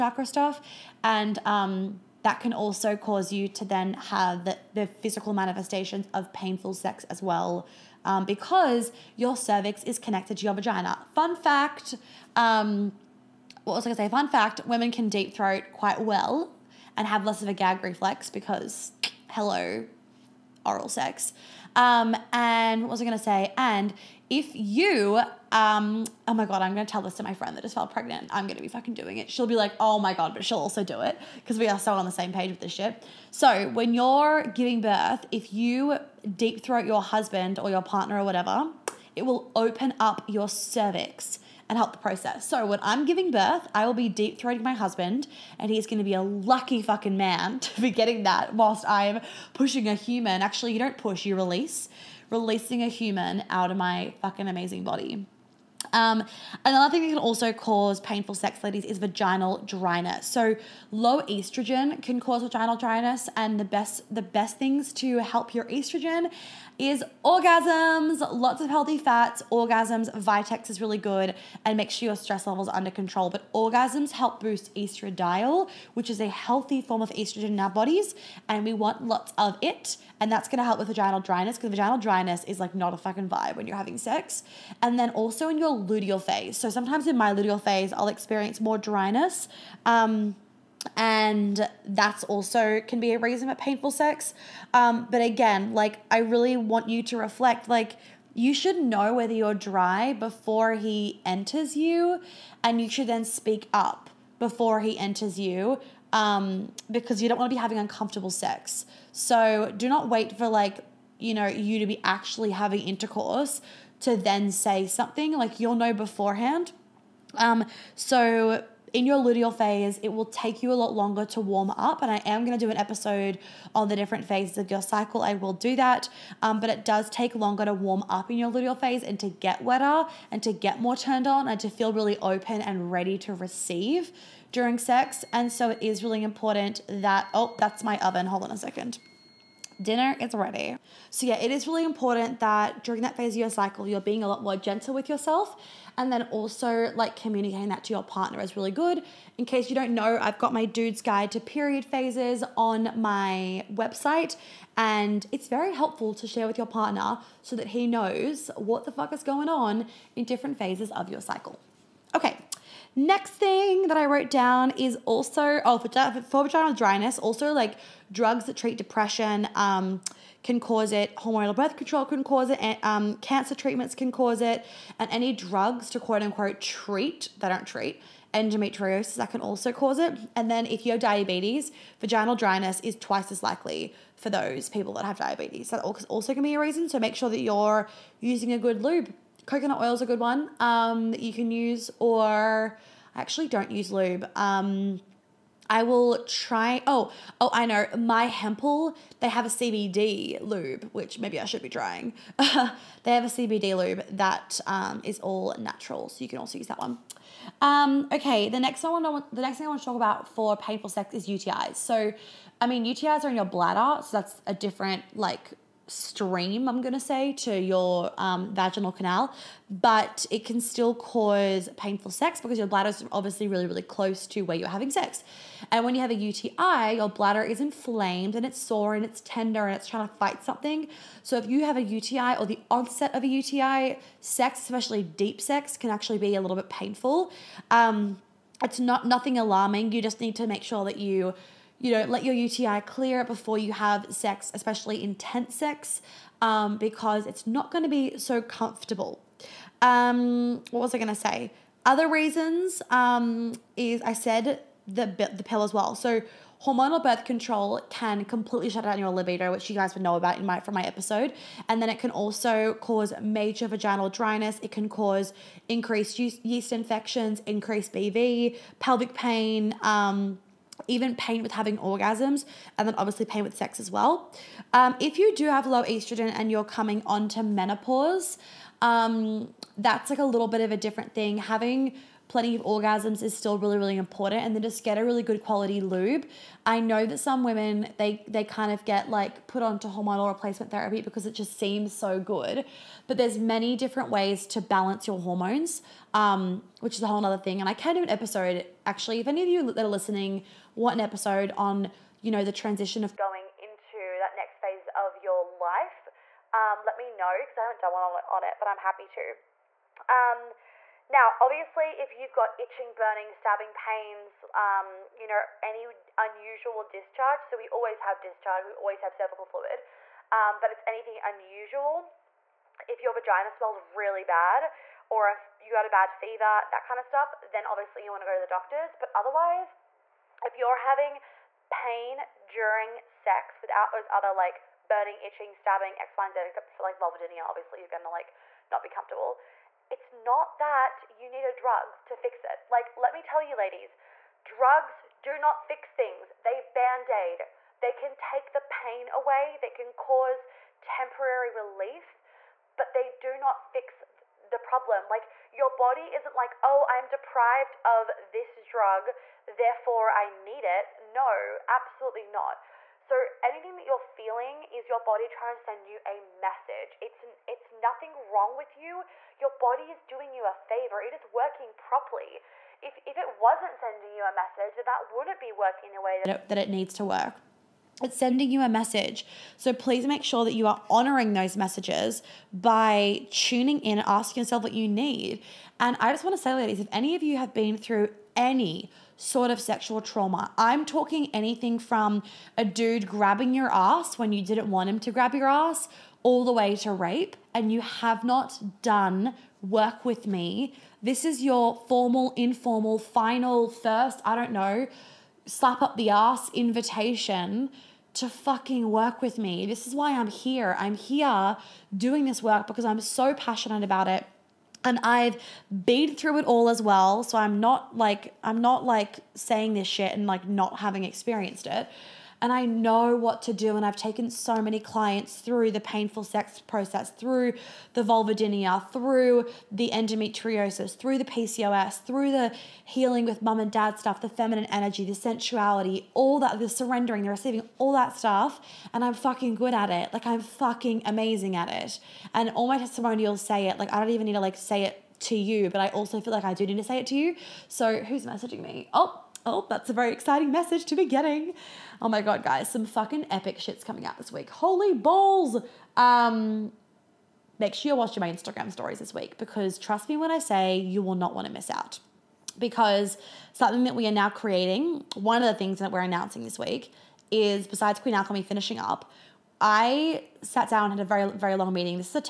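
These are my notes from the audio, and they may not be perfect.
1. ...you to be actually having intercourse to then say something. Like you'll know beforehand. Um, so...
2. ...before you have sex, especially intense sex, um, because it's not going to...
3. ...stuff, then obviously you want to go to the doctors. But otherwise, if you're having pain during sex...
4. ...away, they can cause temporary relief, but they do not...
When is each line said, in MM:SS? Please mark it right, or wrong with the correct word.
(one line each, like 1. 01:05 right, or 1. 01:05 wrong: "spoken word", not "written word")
1. 01:51 right
2. 04:03 right
3. 05:27 right
4. 05:49 right.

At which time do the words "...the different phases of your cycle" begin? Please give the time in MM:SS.
02:03.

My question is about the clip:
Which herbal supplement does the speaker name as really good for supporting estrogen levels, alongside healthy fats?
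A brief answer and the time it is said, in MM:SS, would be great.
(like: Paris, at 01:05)
Vitex, at 01:10.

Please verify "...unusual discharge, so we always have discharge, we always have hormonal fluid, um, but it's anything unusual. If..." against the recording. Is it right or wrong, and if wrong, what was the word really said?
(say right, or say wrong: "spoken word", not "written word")
wrong: "cervical", not "hormonal".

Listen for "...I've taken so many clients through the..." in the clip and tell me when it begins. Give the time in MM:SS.
07:03.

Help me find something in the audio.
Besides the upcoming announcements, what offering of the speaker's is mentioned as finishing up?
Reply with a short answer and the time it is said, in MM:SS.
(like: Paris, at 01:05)
Queen Alchemy, at 07:47.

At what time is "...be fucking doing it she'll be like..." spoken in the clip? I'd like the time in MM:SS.
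00:28.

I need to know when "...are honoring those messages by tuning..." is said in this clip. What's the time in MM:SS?
06:20.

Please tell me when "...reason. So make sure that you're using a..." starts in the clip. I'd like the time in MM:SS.
03:06.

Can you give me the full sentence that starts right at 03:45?
And when you have a UTI, your bladder is inflamed and it's sore and it's tender and it's trying to fight something.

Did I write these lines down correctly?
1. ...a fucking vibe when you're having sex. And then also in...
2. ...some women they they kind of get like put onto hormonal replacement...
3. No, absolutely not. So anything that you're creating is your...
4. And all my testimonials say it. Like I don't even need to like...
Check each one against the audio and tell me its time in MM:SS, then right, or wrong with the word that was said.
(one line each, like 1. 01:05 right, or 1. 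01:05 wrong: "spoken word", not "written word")
1. 01:22 right
2. 04:47 right
3. 06:00 wrong: "feeling", not "creating"
4. 07:22 right.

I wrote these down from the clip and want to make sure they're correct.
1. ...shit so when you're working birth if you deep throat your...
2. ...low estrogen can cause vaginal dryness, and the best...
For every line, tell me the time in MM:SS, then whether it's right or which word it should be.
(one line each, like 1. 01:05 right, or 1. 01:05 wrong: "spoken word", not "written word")
1. 00:32 wrong: "giving", not "working"
2. 01:00 right.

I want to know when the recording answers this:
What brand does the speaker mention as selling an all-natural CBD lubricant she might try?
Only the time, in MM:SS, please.
03:18.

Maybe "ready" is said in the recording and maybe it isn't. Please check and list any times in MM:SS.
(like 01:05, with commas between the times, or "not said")
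02:12, 02:20.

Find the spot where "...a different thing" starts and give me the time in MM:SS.
04:40.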